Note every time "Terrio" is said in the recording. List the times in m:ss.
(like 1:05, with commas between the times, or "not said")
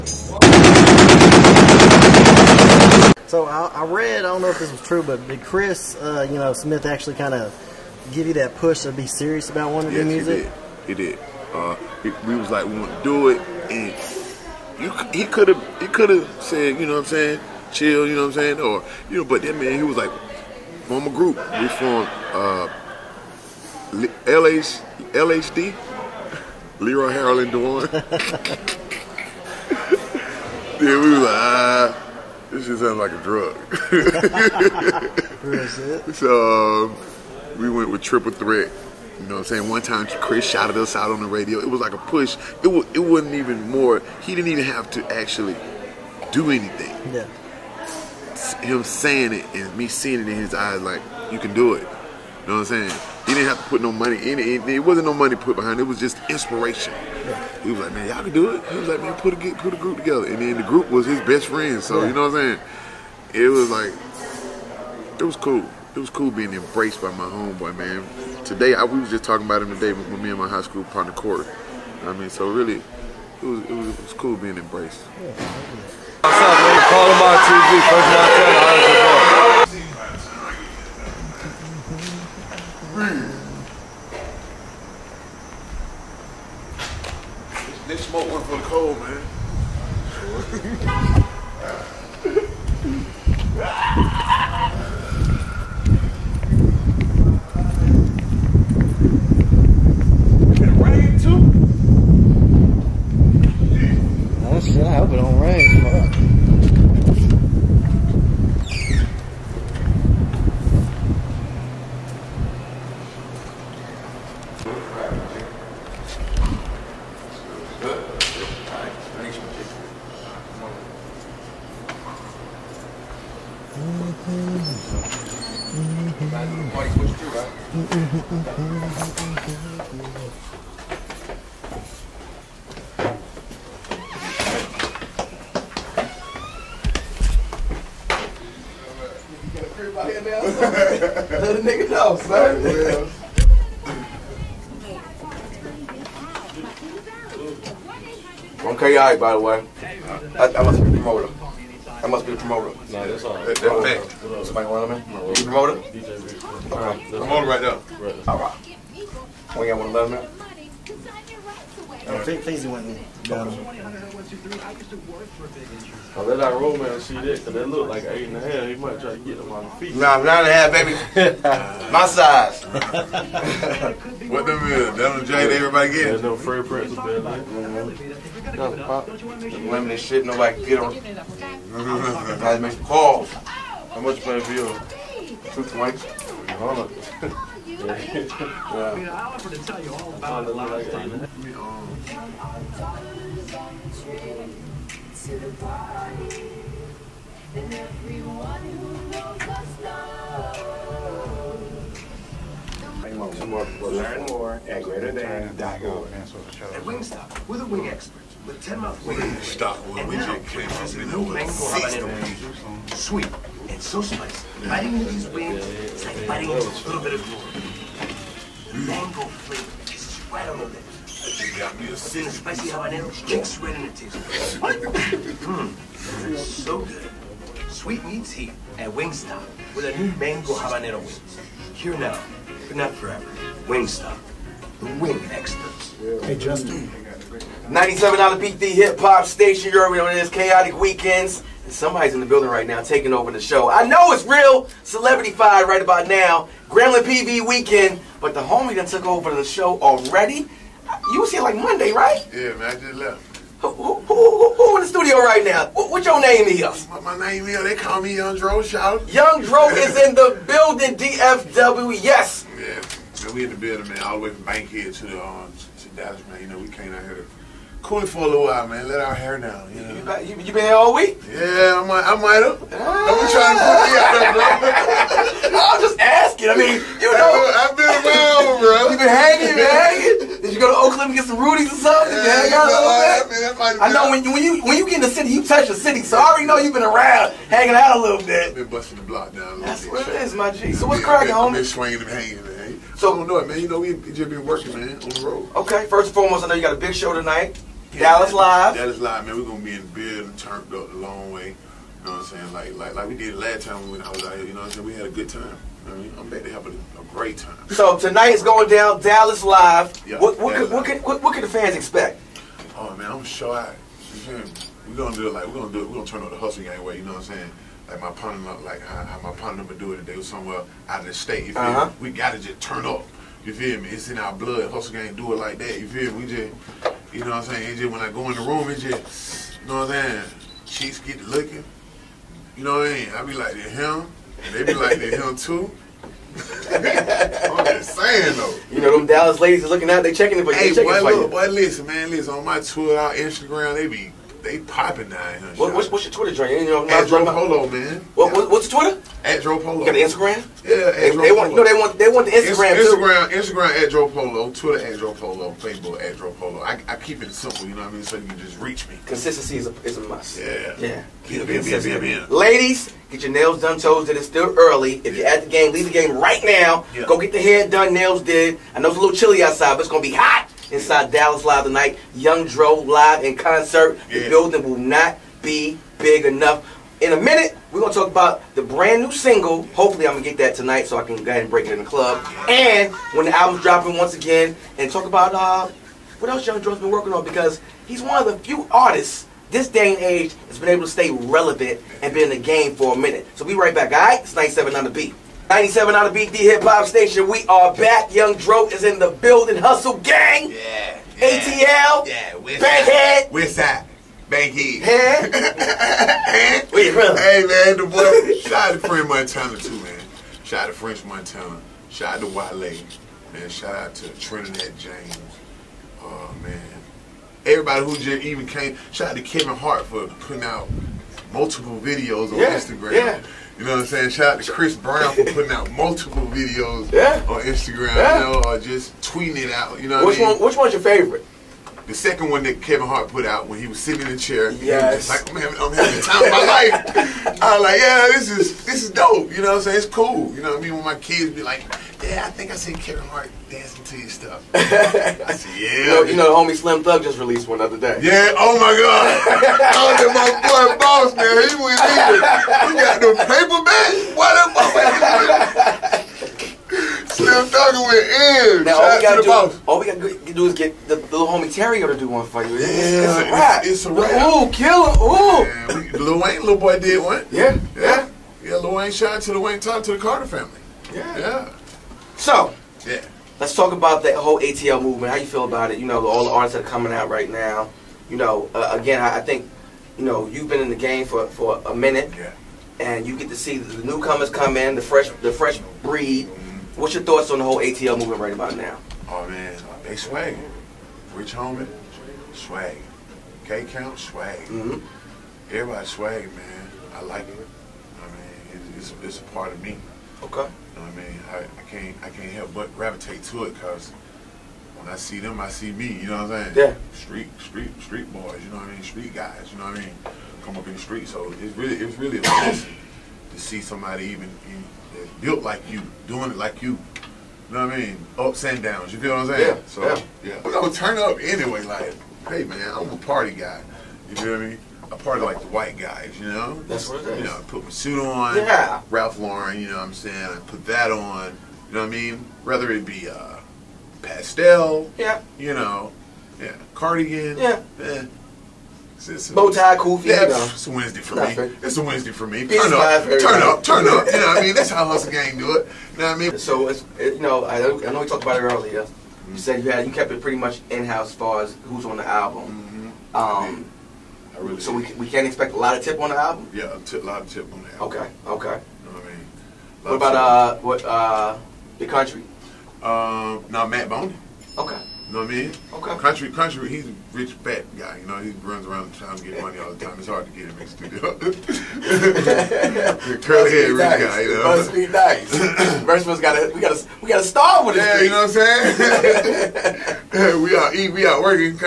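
7:41.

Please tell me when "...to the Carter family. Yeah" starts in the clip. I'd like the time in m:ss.
7:49.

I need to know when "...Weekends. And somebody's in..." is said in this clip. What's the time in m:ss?
4:00.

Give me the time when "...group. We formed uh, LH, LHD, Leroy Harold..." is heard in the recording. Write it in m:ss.
0:21.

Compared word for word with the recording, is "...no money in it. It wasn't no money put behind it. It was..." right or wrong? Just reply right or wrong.
right.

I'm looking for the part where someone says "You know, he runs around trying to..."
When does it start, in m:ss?
9:27.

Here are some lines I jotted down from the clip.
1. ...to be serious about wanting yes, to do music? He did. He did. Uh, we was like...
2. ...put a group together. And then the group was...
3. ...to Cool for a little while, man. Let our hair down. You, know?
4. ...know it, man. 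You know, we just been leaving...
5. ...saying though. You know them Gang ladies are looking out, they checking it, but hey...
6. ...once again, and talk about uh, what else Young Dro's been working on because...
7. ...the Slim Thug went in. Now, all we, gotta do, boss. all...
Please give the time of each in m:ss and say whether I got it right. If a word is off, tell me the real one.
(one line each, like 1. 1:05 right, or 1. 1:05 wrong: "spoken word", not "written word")
1. 0:08 right
2. 0:59 right
3. 4:27 right
4. 4:53 wrong: "working", not "leaving"
5. 5:37 wrong: "Dallas", not "Gang"
6. 6:23 right
7. 7:35 right.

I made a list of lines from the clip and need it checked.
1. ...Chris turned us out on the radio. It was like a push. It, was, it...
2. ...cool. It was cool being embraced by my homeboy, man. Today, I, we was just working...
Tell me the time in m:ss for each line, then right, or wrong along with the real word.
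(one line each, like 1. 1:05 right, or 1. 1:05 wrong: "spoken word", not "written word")
1. 0:40 wrong: "shouted", not "turned"
2. 1:05 wrong: "talking", not "working".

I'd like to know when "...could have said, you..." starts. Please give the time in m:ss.
0:15.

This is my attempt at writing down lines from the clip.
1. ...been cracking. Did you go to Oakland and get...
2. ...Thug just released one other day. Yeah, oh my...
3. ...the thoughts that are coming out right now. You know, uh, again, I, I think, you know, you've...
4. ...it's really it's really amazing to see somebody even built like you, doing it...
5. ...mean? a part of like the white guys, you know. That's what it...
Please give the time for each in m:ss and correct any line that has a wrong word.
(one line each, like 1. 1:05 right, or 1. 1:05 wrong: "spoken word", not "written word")
1. 4:39 wrong: "hanging", not "cracking"
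2. 7:26 right
3. 7:56 wrong: "artists", not "thoughts"
4. 8:31 right
5. 8:44 right.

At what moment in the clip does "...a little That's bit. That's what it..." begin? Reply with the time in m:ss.
4:49.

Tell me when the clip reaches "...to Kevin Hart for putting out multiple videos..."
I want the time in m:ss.
6:59.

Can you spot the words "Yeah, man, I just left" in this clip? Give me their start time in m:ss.
4:12.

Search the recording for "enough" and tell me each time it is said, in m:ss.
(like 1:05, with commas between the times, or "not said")
6:16.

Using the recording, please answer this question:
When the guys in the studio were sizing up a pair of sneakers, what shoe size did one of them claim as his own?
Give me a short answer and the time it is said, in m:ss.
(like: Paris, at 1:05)
9.5, at 2:50.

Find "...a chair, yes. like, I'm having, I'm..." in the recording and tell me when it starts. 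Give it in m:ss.
7:14.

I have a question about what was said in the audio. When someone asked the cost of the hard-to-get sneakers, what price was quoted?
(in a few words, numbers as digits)
220.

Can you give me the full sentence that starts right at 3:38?
The mango flavor is right on the lips.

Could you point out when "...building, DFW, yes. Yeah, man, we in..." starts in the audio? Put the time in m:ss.
4:20.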